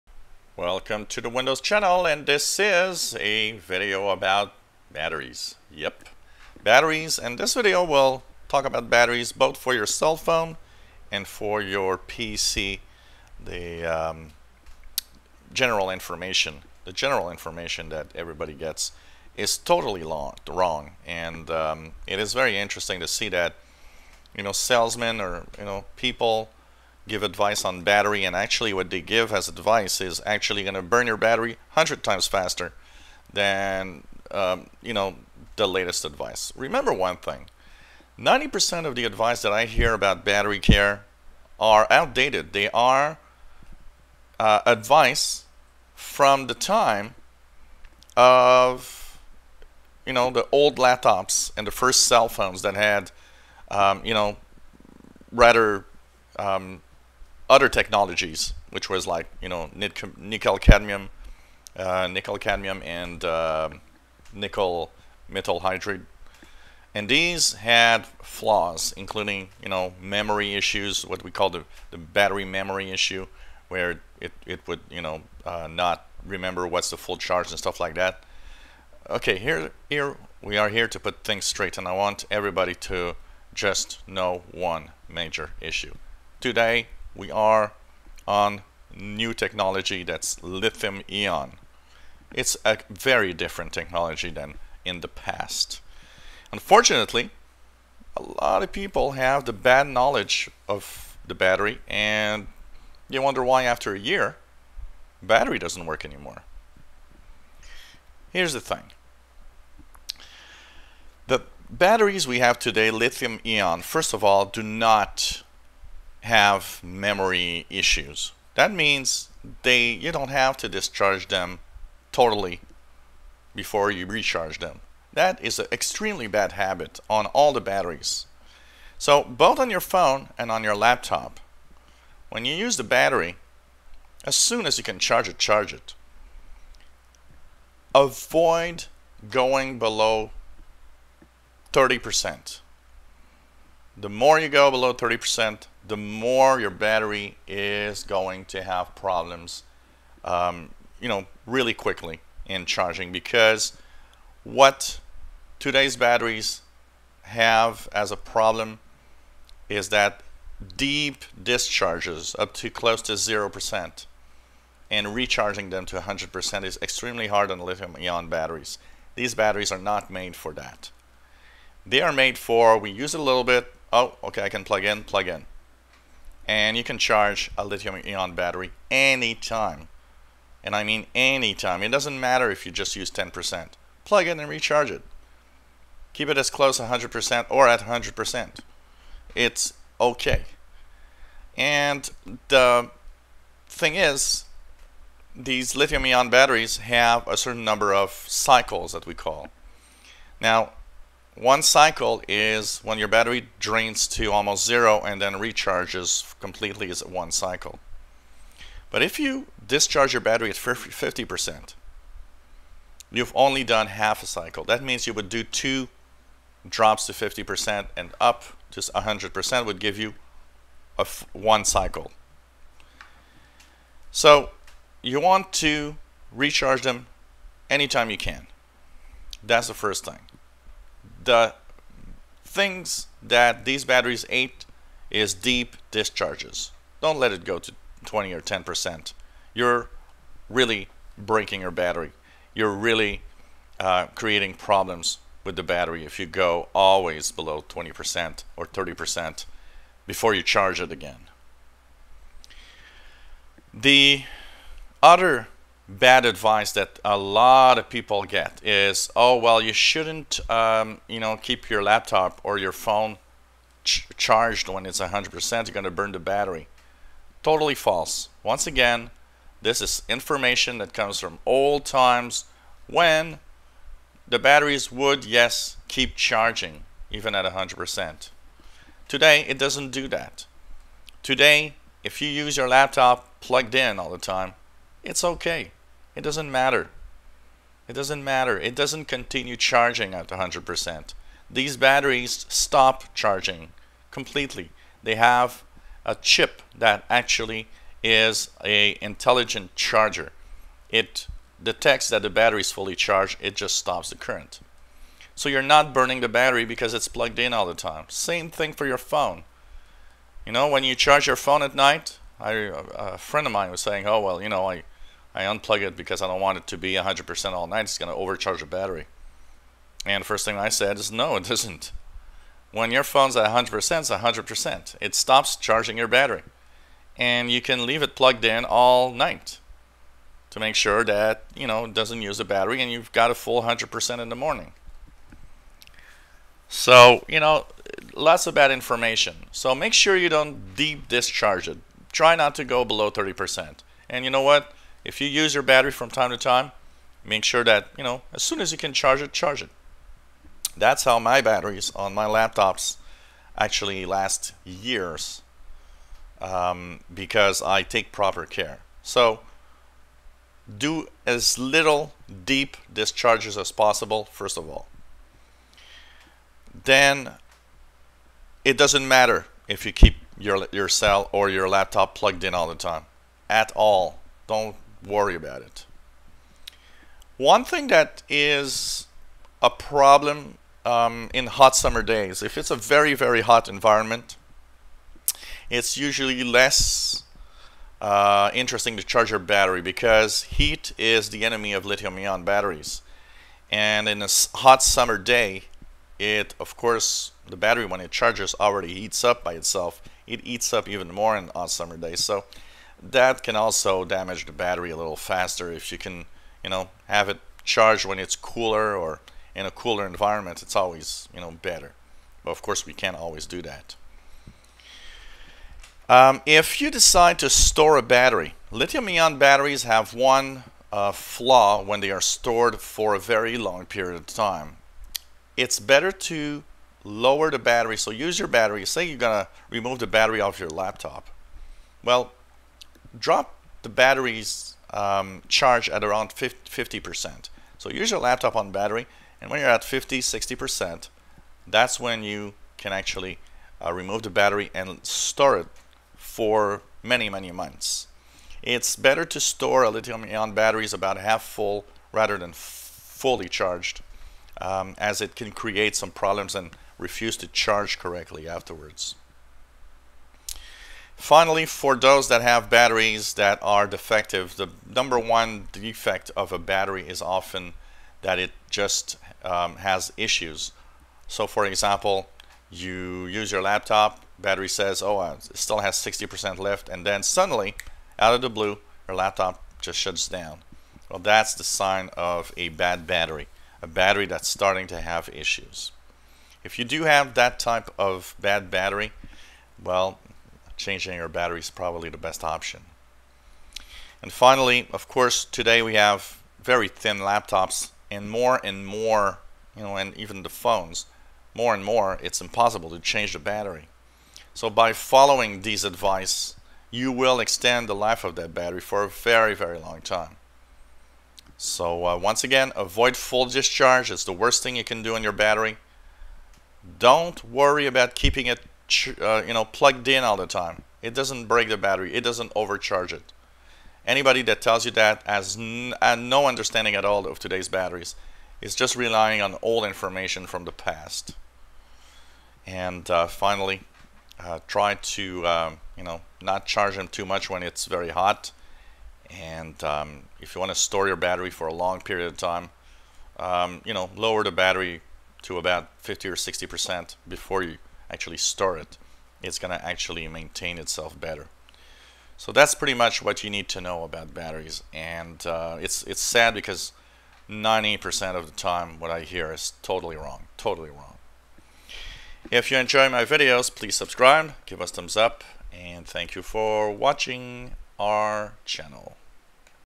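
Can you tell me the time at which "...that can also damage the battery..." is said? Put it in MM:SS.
06:43.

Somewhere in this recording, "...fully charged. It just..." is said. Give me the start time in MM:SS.
05:02.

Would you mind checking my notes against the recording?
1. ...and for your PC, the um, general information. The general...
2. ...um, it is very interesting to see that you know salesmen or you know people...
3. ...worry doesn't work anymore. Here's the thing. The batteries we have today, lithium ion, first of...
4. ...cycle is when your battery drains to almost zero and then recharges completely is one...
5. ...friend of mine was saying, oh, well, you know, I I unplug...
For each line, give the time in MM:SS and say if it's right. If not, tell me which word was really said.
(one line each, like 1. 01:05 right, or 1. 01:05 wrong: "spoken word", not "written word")
1. 00:11 right
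2. 00:21 right
3. 01:45 wrong: "battery", not "worry"
4. 03:21 right
5. 05:13 right.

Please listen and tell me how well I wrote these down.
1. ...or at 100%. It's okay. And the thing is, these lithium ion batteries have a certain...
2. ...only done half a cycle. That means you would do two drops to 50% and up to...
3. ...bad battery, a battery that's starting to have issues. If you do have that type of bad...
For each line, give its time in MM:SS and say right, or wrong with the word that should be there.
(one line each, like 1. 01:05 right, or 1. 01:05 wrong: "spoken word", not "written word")
1. 03:07 right
2. 03:33 right
3. 08:02 right.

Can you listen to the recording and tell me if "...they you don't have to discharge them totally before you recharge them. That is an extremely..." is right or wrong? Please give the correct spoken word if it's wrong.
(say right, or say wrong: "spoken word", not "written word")
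right.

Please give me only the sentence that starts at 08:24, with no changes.
So by following these advice, you will extend the life of that battery for a very, very long time.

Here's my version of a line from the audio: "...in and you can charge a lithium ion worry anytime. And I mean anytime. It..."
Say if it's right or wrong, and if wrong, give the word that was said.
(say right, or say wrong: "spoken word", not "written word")
wrong: "battery", not "worry".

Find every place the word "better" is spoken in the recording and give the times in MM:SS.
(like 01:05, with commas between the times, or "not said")
06:51, 07:05, 07:28, 09:11.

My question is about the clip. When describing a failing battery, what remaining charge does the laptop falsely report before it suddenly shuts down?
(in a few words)
60%.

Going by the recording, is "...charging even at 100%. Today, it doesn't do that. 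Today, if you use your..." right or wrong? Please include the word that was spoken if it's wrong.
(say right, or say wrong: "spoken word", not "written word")
right.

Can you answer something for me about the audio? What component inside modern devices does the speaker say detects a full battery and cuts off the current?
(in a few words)
intelligent charger.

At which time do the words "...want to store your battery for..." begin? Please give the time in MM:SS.
09:00.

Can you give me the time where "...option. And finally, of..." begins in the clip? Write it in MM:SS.
08:12.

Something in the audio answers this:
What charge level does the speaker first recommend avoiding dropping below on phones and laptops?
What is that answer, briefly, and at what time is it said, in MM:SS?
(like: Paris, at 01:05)
30%, at 02:17.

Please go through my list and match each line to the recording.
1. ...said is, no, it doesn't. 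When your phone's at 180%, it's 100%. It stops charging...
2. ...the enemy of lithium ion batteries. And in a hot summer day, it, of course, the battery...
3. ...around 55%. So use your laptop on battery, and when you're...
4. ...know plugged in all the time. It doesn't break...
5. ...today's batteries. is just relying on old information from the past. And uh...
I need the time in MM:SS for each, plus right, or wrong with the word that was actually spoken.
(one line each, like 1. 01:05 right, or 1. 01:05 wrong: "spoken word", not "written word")
1. 05:20 wrong: "100", not "180"
2. 06:31 right
3. 07:16 wrong: "50", not "55"
4. 08:39 right
5. 08:47 right.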